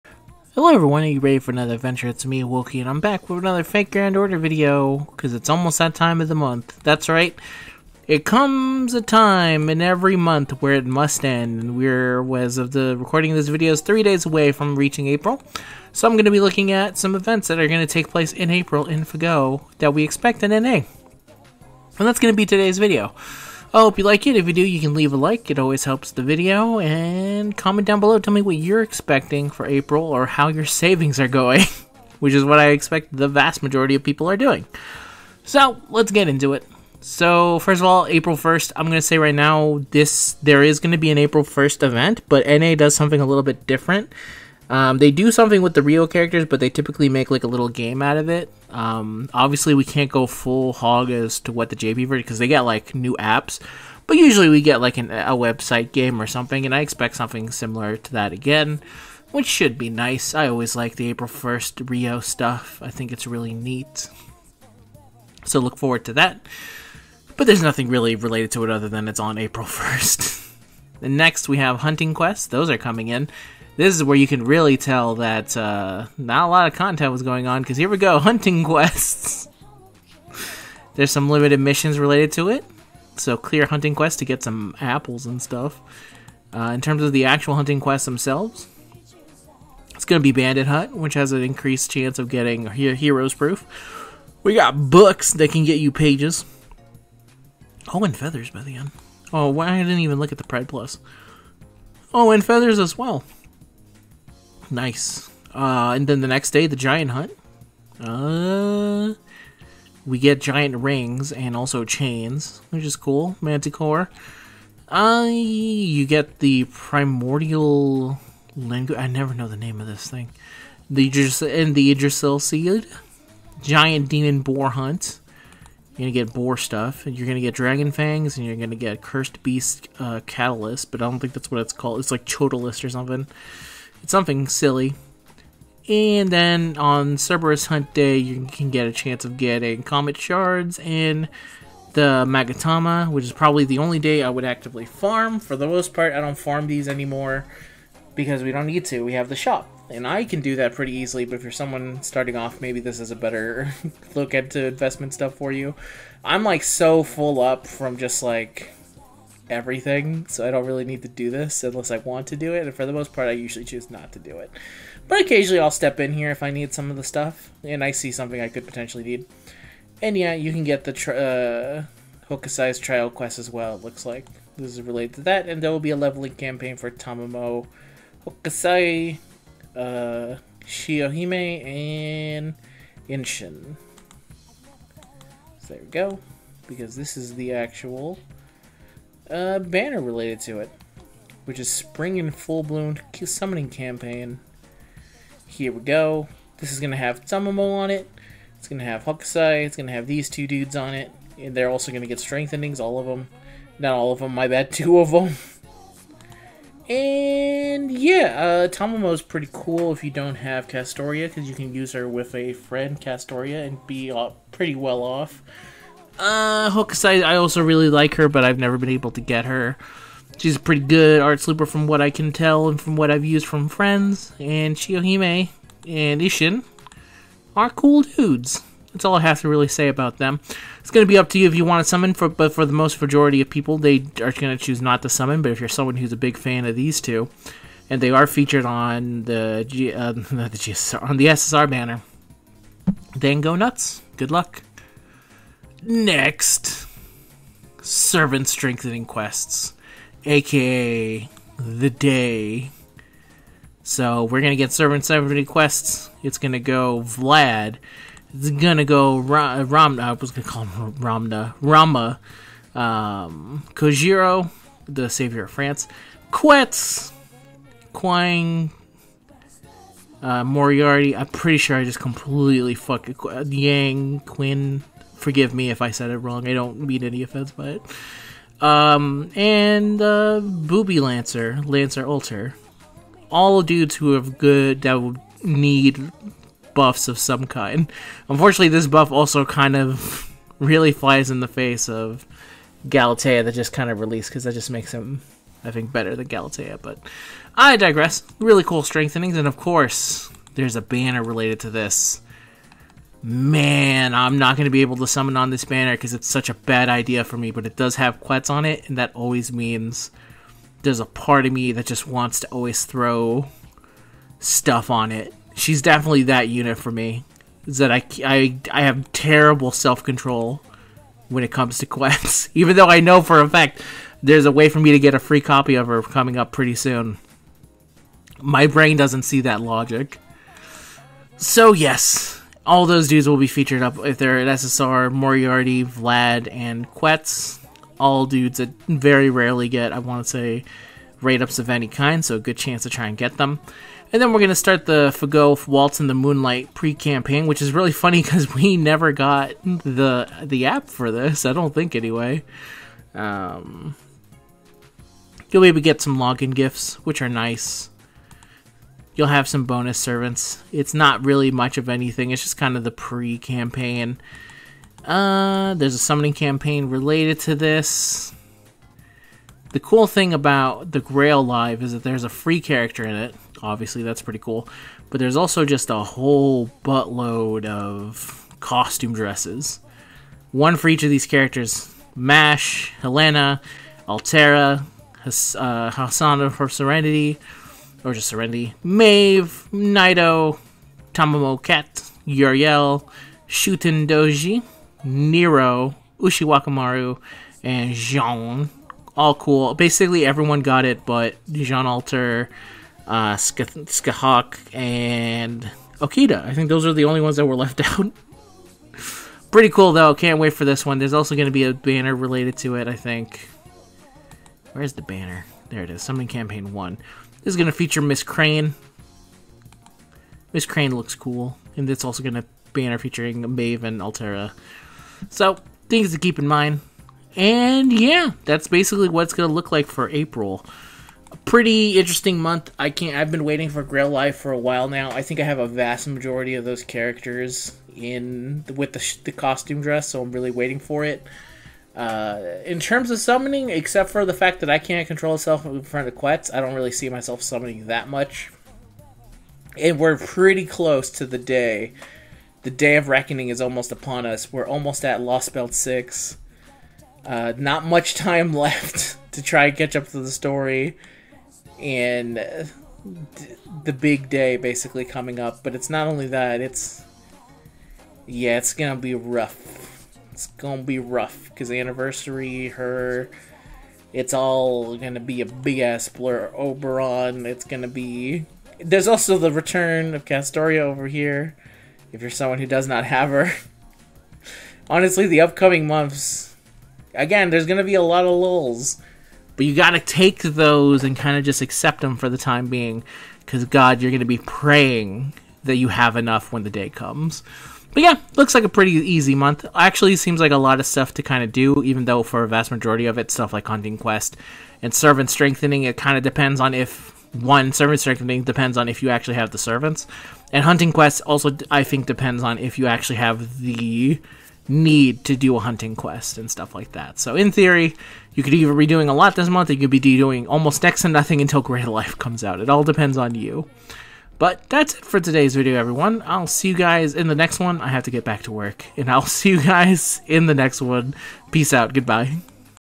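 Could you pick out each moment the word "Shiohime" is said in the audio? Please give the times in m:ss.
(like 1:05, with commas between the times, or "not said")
3:00, 3:44.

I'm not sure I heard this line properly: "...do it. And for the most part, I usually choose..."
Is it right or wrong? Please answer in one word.
right.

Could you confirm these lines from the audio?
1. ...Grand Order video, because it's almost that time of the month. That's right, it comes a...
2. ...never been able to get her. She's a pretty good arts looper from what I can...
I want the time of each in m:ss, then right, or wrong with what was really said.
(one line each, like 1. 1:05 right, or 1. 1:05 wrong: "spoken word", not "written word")
1. 0:03 right
2. 3:38 right.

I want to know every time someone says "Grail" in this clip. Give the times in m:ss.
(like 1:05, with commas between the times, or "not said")
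6:10, 7:13.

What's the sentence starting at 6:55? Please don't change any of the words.
There it is, Summoning Campaign 1.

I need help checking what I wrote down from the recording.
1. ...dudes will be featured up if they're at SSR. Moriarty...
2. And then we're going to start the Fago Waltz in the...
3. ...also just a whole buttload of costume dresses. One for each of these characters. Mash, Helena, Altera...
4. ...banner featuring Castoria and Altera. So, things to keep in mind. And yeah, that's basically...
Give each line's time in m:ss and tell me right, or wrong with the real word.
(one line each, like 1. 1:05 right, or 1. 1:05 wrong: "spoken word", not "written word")
1. 5:33 right
2. 5:44 right
3. 6:15 right
4. 7:02 wrong: "Maeve", not "Castoria".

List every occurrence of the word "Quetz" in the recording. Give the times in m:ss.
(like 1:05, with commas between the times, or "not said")
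4:26, 5:08, 5:21, 5:36, 7:26.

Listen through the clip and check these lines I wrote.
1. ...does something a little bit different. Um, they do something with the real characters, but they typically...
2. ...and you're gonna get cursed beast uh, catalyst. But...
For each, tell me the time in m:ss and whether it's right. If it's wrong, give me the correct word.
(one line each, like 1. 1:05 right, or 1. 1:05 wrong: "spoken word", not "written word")
1. 0:42 right
2. 2:08 right.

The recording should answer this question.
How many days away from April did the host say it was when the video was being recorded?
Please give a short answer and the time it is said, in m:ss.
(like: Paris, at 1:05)
3, at 0:13.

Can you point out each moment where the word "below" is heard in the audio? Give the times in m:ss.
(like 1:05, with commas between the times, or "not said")
0:28.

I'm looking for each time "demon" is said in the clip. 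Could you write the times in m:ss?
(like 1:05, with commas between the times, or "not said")
2:04.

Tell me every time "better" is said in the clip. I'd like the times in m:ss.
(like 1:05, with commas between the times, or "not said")
2:33, 4:55.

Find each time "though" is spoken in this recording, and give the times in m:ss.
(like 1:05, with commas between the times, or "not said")
5:22, 6:49, 8:22.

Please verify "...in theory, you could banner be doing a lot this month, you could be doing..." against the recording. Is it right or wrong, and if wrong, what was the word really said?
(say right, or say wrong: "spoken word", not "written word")
wrong: "either", not "banner".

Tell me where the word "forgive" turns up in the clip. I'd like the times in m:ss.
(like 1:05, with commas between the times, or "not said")
4:35.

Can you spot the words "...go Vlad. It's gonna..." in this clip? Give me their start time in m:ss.
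4:16.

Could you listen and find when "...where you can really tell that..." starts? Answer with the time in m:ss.
1:14.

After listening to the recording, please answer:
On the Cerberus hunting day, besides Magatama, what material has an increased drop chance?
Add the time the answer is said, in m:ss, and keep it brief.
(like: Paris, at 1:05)
Comet Shards, at 2:19.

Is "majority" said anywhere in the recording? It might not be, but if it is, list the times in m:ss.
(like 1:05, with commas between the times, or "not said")
0:33, 3:53, 7:16, 8:22.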